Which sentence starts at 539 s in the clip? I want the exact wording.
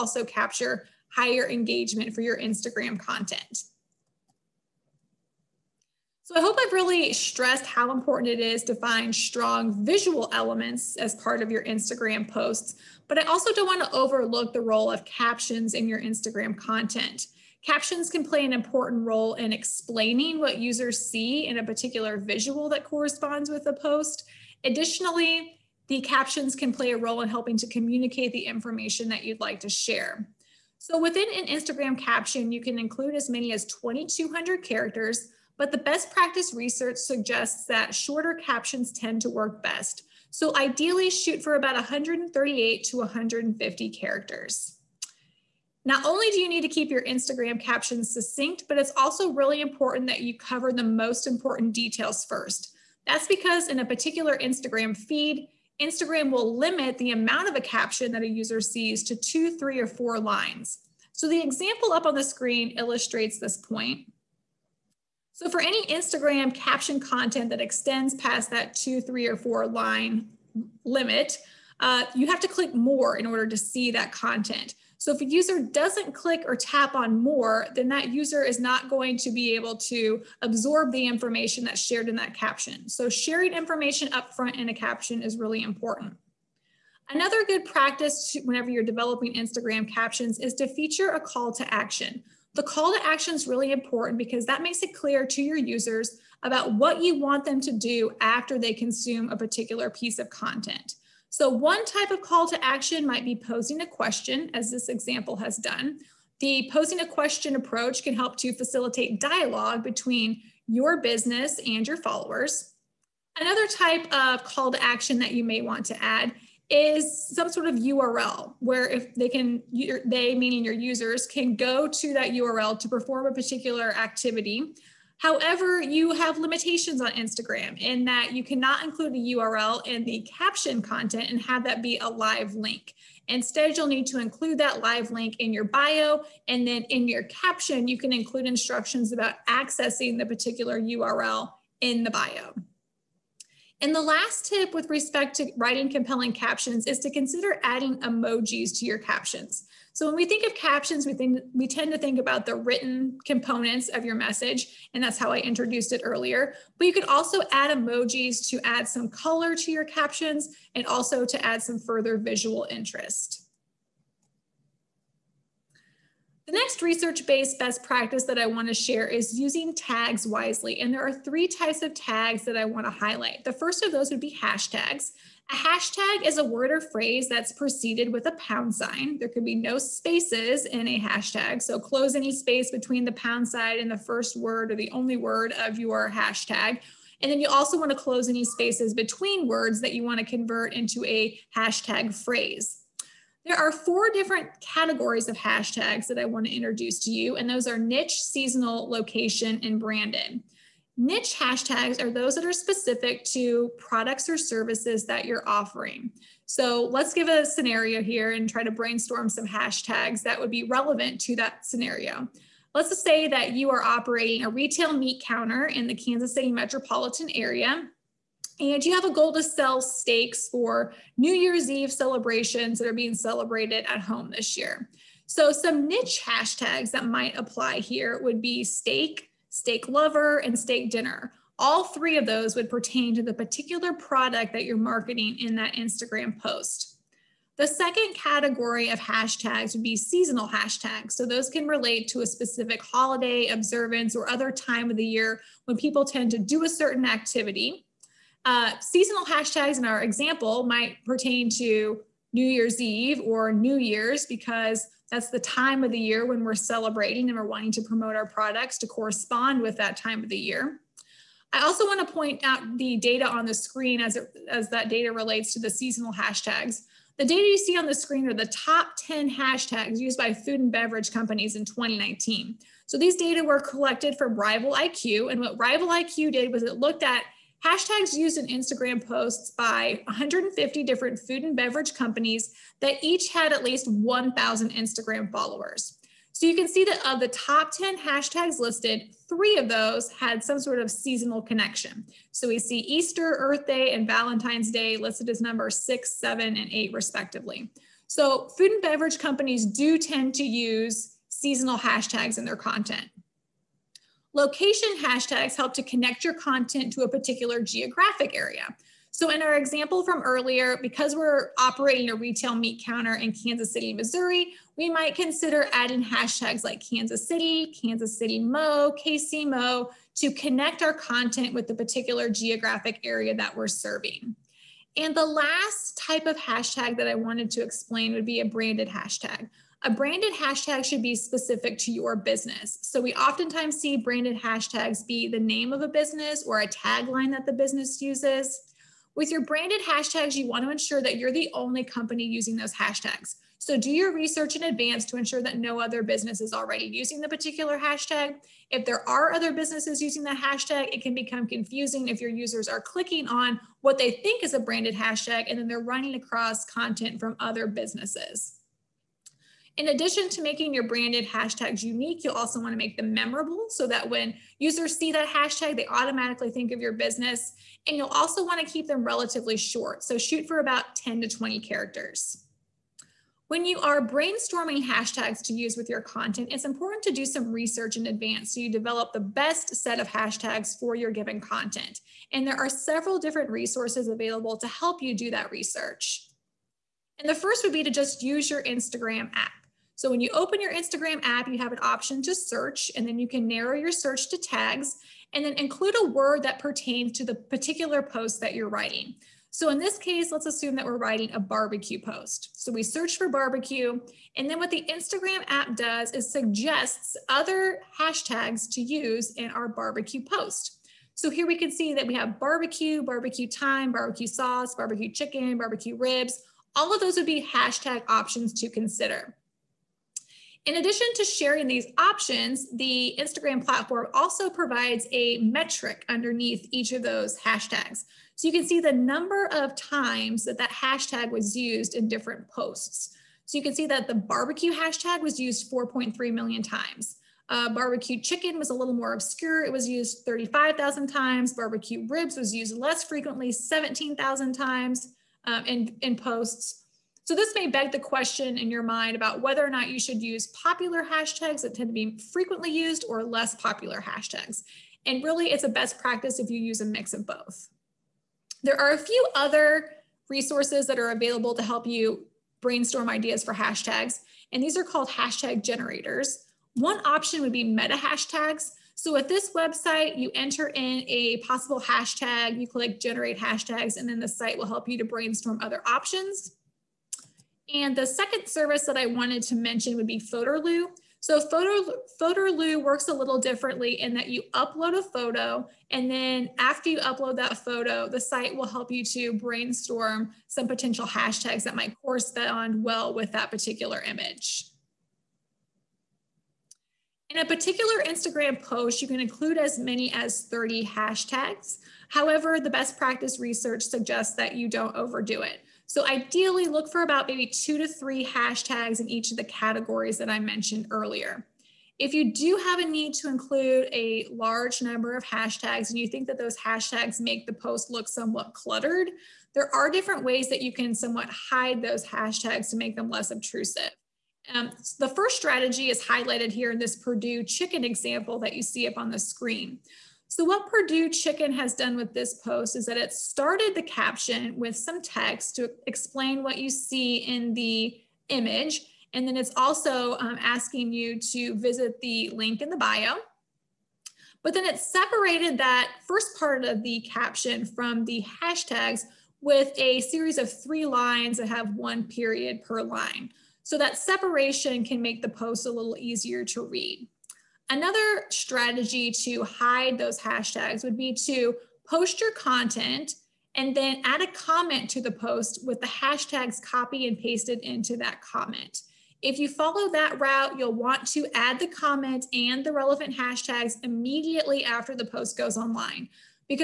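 And then it's also um, asking you to visit the link in the bio.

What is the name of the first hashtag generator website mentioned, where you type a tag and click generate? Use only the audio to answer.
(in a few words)
Meta Hashtags.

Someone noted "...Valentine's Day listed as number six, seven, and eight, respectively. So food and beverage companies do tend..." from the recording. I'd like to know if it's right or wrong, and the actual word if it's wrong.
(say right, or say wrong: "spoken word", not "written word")
right.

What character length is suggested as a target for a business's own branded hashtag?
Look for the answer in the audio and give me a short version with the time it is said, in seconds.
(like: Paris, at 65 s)
10 to 20 characters, at 370 s.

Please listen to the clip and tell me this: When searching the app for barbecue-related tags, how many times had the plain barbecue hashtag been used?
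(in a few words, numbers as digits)
4.3 million.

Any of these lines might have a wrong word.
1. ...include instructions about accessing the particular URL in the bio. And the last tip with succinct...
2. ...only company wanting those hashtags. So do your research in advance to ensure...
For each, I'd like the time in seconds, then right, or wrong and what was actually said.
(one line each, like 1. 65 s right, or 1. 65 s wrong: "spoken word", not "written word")
1. 138 s wrong: "respect", not "succinct"
2. 341 s wrong: "using", not "wanting".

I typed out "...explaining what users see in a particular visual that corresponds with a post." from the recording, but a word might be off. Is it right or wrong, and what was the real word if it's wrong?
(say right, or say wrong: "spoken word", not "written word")
right.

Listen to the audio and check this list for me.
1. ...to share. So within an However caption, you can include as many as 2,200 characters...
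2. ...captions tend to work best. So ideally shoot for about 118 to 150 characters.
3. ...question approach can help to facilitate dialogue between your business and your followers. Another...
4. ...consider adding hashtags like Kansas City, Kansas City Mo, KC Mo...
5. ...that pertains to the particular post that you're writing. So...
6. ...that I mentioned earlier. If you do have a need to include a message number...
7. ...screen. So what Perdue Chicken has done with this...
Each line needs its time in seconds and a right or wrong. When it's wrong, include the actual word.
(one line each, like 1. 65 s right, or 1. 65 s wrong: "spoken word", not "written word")
1. 29 s wrong: "Instagram", not "However"
2. 38 s wrong: "138", not "118"
3. 107 s right
4. 315 s right
5. 396 s right
6. 510 s wrong: "large", not "message"
7. 529 s right.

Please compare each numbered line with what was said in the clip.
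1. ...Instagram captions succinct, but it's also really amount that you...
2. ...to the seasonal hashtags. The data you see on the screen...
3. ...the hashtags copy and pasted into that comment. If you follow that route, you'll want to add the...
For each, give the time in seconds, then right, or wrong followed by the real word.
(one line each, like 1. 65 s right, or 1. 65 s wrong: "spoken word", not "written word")
1. 47 s wrong: "important", not "amount"
2. 265 s right
3. 565 s right.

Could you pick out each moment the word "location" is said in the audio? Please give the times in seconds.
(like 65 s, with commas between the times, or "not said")
198 s, 304 s.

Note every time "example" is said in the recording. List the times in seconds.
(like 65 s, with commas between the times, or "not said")
61 s, 104 s, 250 s, 309 s, 527 s.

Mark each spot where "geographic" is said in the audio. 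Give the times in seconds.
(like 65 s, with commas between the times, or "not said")
307 s, 322 s.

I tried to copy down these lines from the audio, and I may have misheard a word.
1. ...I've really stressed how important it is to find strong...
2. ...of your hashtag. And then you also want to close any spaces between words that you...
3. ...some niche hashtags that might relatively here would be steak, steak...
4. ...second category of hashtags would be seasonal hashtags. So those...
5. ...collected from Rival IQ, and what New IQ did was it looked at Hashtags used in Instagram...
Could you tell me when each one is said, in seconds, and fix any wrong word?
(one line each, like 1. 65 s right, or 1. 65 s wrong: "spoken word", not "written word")
1. 6 s right
2. 185 s right
3. 225 s wrong: "apply", not "relatively"
4. 237 s right
5. 273 s wrong: "Rival", not "New".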